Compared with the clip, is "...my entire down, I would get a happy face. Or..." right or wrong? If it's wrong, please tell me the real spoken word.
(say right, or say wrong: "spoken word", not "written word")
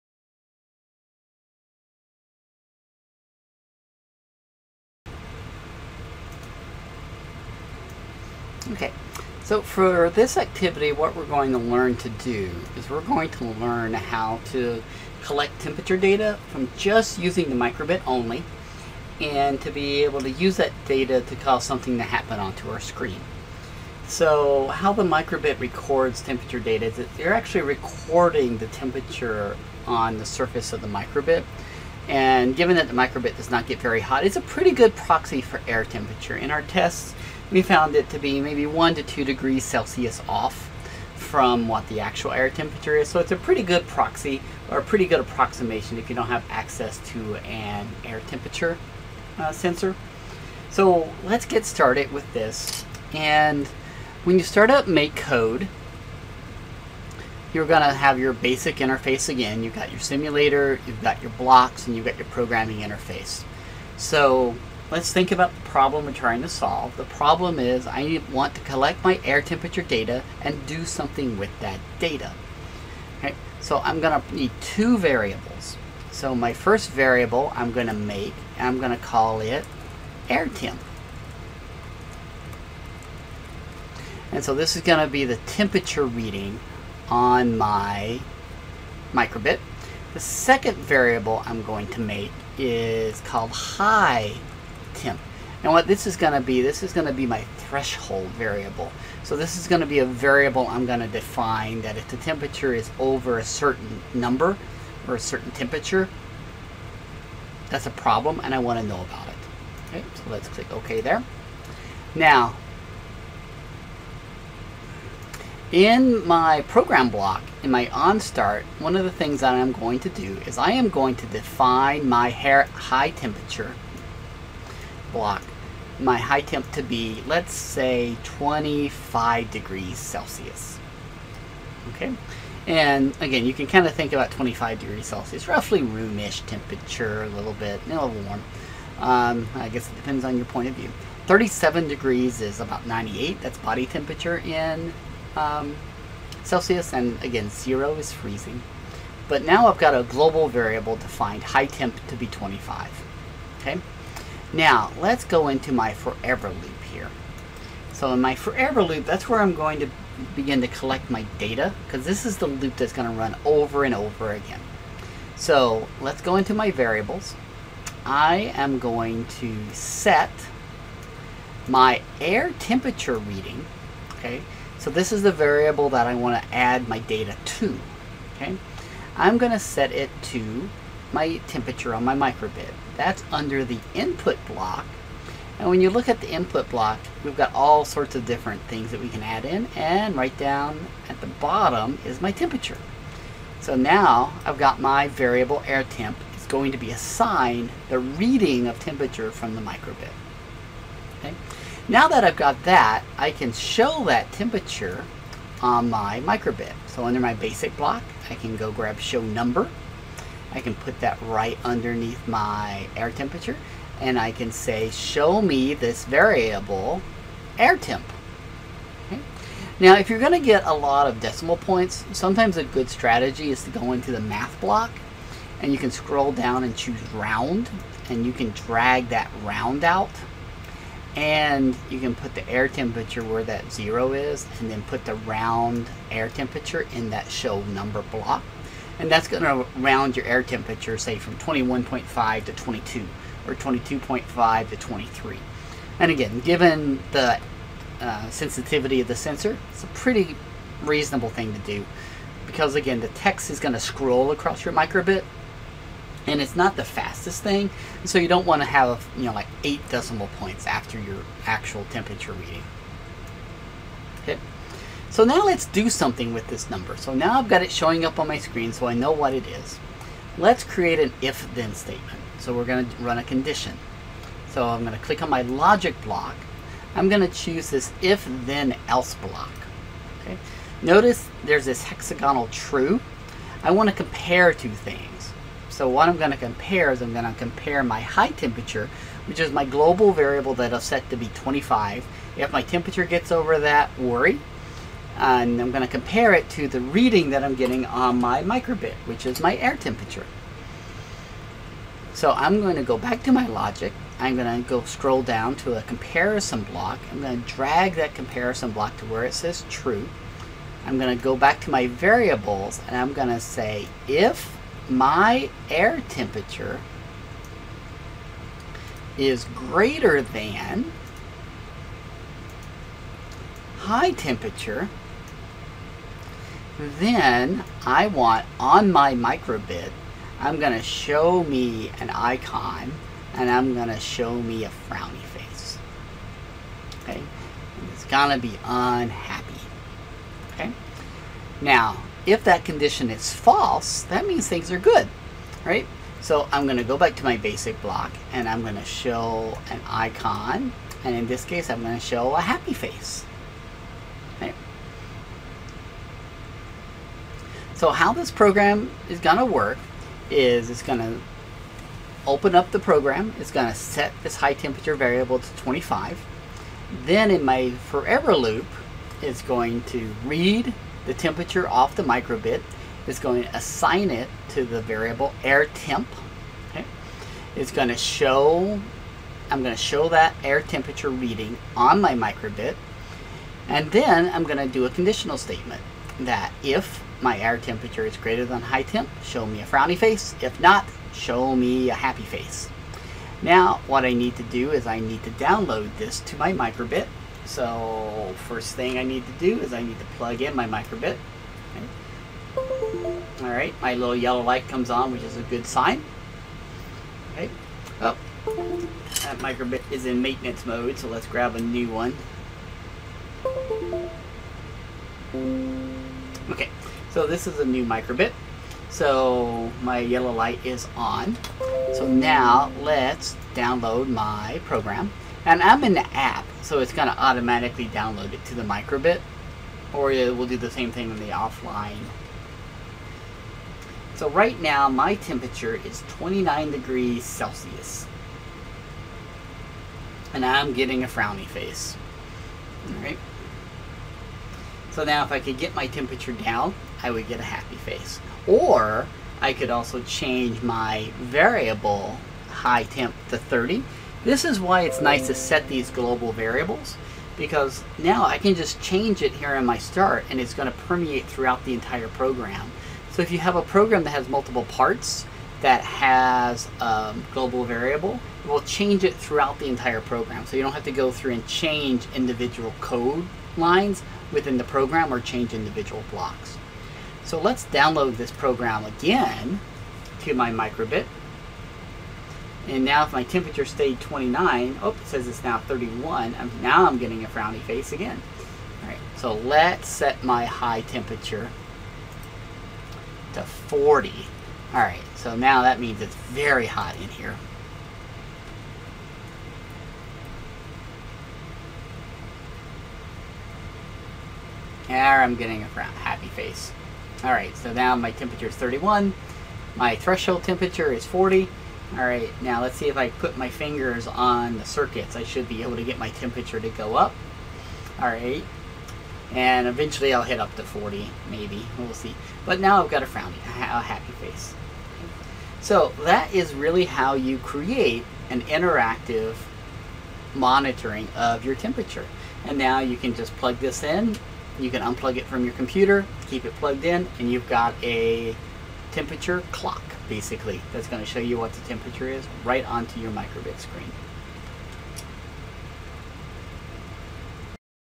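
wrong: "temperature", not "entire".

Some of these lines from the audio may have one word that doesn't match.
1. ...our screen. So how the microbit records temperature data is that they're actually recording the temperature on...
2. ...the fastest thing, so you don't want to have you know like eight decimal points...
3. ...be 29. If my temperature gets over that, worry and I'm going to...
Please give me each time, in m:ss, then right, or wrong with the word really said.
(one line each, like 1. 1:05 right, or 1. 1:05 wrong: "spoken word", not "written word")
1. 0:22 right
2. 4:16 right
3. 4:51 wrong: "25", not "29".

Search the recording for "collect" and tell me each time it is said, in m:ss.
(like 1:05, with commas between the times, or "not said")
0:15, 1:08, 2:40.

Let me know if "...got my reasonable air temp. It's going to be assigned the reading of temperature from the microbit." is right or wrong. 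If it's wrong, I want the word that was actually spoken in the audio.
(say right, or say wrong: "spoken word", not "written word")
wrong: "variable", not "reasonable".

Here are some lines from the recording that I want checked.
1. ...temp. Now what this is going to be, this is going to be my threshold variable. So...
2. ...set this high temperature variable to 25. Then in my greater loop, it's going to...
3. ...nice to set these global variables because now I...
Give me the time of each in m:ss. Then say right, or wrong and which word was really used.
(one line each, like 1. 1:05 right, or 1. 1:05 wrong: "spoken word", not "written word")
1. 1:34 right
2. 6:03 wrong: "forever", not "greater"
3. 7:35 right.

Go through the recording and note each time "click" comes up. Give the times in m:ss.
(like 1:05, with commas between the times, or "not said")
1:50, 4:35.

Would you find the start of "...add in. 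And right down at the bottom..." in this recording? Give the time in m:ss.
3:09.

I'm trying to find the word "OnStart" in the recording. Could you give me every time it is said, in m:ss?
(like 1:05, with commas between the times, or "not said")
1:57.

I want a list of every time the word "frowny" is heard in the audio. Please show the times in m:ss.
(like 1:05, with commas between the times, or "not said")
5:34, 6:29, 7:21, 8:07, 8:43.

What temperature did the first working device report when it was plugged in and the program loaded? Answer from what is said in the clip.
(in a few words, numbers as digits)
29 degrees Celsius.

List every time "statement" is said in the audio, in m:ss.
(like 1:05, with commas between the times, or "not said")
4:31, 6:25.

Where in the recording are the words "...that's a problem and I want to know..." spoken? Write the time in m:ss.
1:47.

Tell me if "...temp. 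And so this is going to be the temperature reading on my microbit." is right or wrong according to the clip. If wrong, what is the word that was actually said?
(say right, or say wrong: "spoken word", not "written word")
right.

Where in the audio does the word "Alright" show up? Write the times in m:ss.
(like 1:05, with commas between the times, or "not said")
6:43, 7:22, 8:27, 8:31, 8:38.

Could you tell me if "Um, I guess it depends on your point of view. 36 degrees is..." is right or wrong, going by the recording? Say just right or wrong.
wrong.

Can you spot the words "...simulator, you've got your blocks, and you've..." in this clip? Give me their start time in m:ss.
0:59.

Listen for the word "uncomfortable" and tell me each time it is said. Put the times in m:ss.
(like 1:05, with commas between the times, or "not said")
not said.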